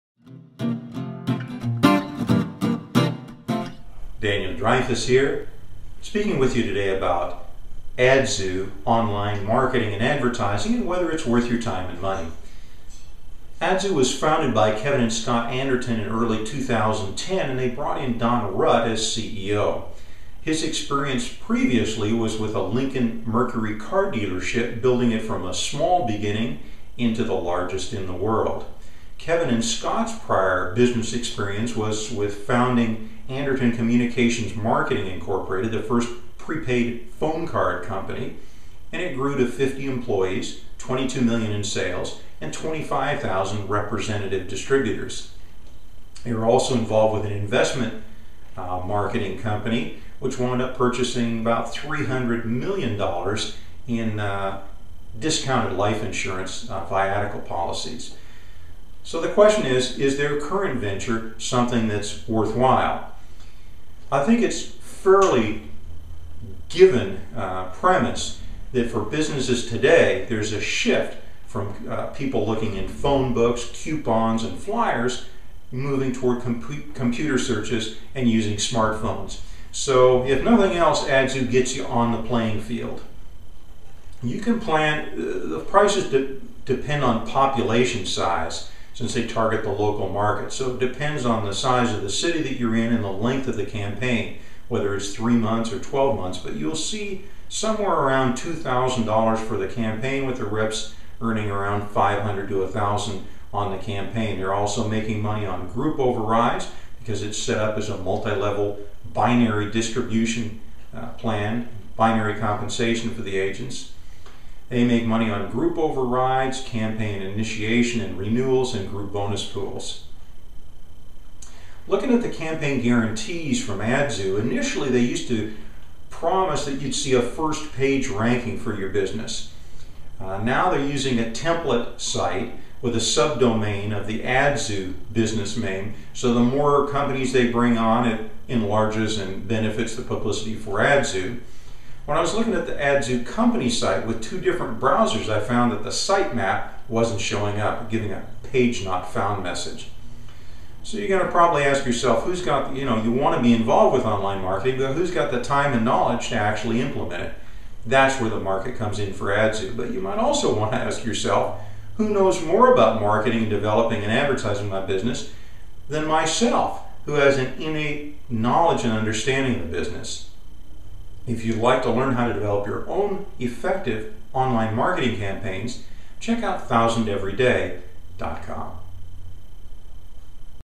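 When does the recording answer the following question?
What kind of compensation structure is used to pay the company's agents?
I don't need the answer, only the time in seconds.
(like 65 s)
111 s.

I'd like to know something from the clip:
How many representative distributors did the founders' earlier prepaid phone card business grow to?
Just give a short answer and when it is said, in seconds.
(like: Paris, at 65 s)
25,000, at 42 s.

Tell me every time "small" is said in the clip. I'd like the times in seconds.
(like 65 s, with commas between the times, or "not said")
25 s.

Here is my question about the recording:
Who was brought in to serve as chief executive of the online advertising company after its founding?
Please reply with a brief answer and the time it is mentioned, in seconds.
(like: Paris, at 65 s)
Don Rutt, at 18 s.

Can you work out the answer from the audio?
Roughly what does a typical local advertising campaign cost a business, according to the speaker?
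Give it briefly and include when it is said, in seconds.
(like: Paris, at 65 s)
$2,000, at 98 s.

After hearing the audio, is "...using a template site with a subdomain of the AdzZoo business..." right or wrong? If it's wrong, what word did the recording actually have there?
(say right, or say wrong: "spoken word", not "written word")
right.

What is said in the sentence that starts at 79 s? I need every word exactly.
So if nothing else, AdzZoo gets you on the playing field.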